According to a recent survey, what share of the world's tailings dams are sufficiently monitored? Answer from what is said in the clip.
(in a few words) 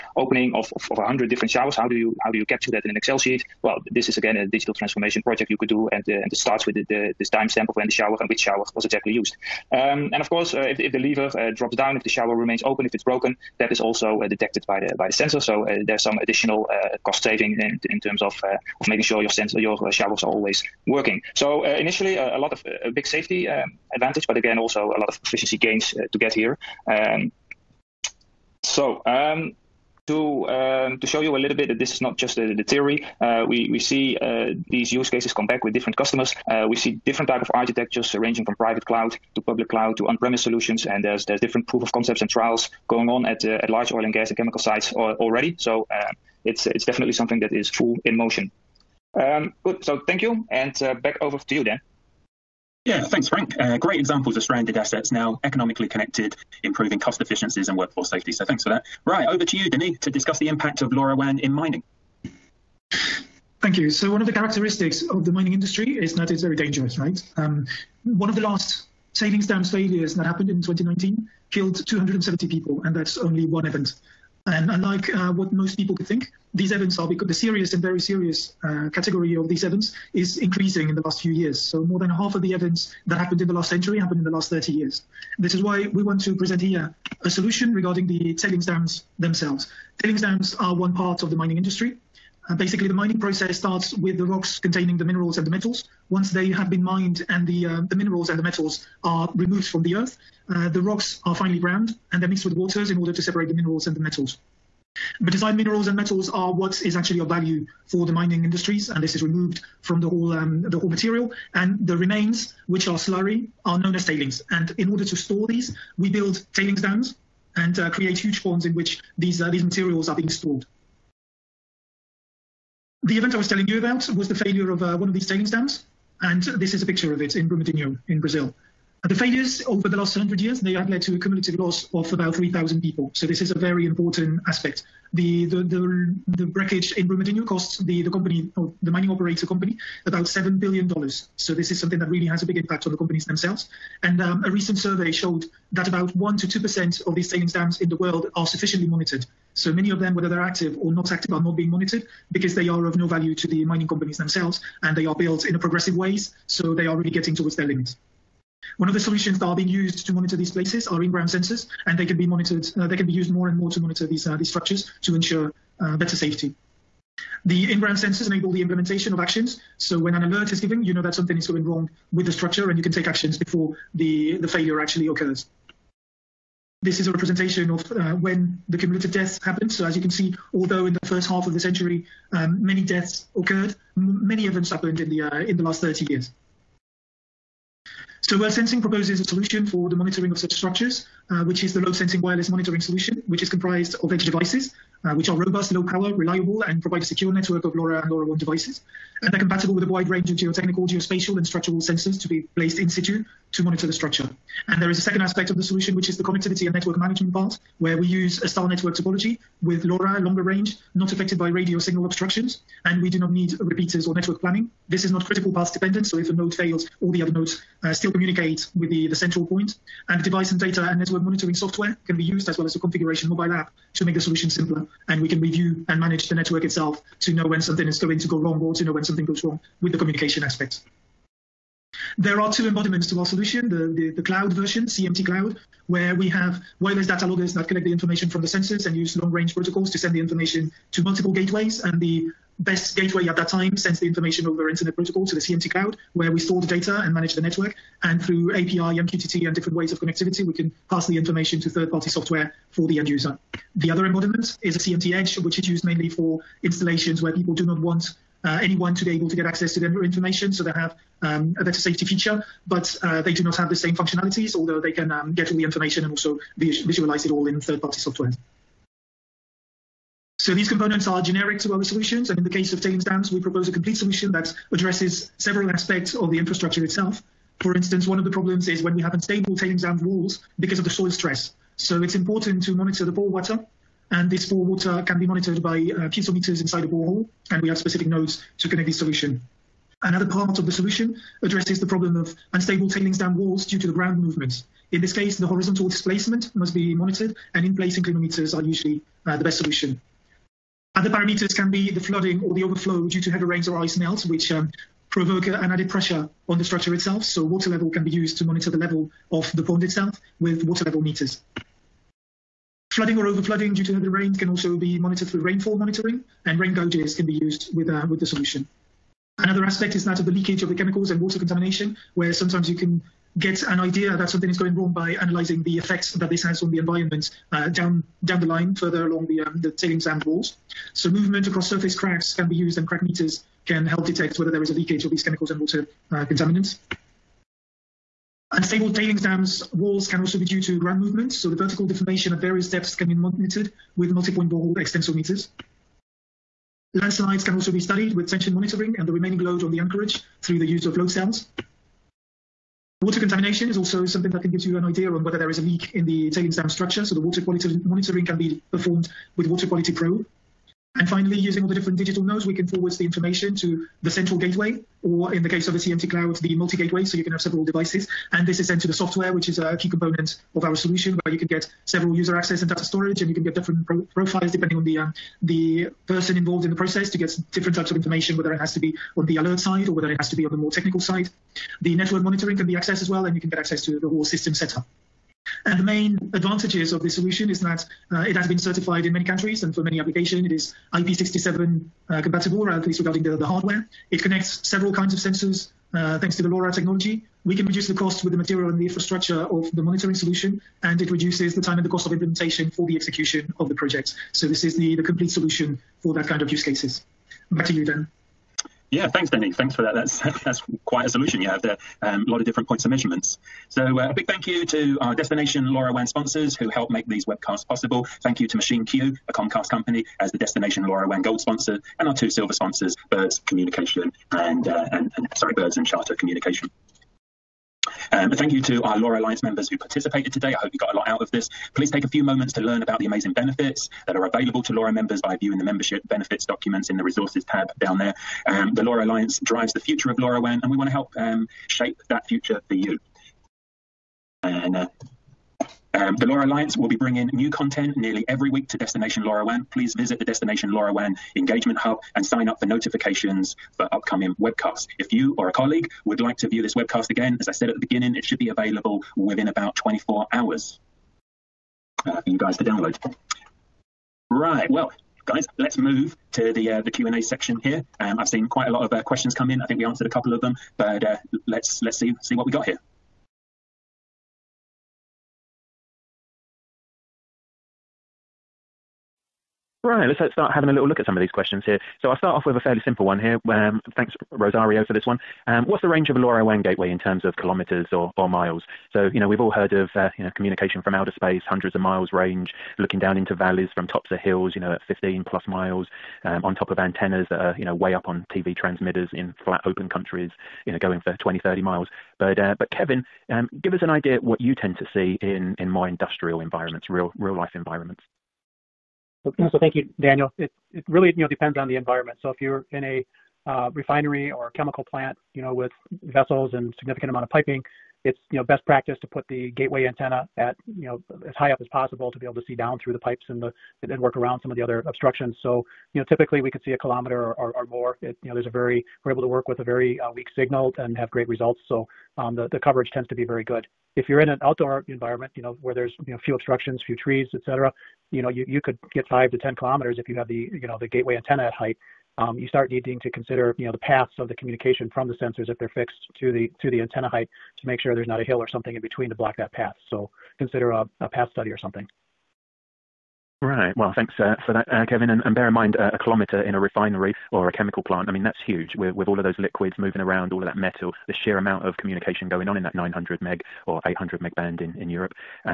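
1 to 2%.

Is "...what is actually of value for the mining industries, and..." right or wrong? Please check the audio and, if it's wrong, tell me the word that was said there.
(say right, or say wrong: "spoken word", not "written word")
right.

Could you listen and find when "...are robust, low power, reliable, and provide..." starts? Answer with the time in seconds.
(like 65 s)
195 s.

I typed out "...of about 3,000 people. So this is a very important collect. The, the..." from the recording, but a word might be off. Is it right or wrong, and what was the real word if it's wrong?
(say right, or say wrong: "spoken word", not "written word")
wrong: "aspect", not "collect".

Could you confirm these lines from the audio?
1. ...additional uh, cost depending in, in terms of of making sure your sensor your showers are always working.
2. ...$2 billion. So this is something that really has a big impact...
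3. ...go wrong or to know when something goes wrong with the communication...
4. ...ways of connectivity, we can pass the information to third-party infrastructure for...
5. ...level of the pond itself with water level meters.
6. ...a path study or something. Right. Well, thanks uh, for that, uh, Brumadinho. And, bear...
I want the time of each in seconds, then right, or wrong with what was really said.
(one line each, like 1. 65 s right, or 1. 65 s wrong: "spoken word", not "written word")
1. 16 s wrong: "saving", not "depending"
2. 140 s wrong: "7", not "2"
3. 228 s right
4. 249 s wrong: "software", not "infrastructure"
5. 308 s right
6. 550 s wrong: "Kevin", not "Brumadinho".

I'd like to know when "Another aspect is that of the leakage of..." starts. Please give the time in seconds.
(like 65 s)
319 s.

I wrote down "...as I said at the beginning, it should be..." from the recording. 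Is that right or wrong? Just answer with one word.
right.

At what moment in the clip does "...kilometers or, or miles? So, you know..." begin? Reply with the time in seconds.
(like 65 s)
487 s.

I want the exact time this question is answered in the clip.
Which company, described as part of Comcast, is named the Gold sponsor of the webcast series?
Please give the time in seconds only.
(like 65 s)
418 s.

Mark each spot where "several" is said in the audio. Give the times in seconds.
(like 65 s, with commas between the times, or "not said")
275 s, 367 s, 371 s, 394 s.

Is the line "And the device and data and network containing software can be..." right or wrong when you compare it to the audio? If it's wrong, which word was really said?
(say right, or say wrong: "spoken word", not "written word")
wrong: "monitoring", not "containing".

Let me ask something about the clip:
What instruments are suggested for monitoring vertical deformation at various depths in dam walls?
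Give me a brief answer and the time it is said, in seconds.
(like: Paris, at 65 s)
Multi-point borehole extensometers, at 344 s.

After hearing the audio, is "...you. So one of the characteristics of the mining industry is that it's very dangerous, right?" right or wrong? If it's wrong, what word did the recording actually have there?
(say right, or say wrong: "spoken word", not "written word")
right.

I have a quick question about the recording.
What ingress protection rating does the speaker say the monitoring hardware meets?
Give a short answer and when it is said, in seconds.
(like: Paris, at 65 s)
IP67, at 390 s.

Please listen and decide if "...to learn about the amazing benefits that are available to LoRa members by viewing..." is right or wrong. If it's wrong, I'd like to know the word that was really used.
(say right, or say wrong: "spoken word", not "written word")
right.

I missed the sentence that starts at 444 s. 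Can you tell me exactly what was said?
And uh, um, the LoRa Alliance will be bringing new content nearly every week to Destination LoRaWAN.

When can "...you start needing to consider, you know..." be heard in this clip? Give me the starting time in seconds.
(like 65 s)
542 s.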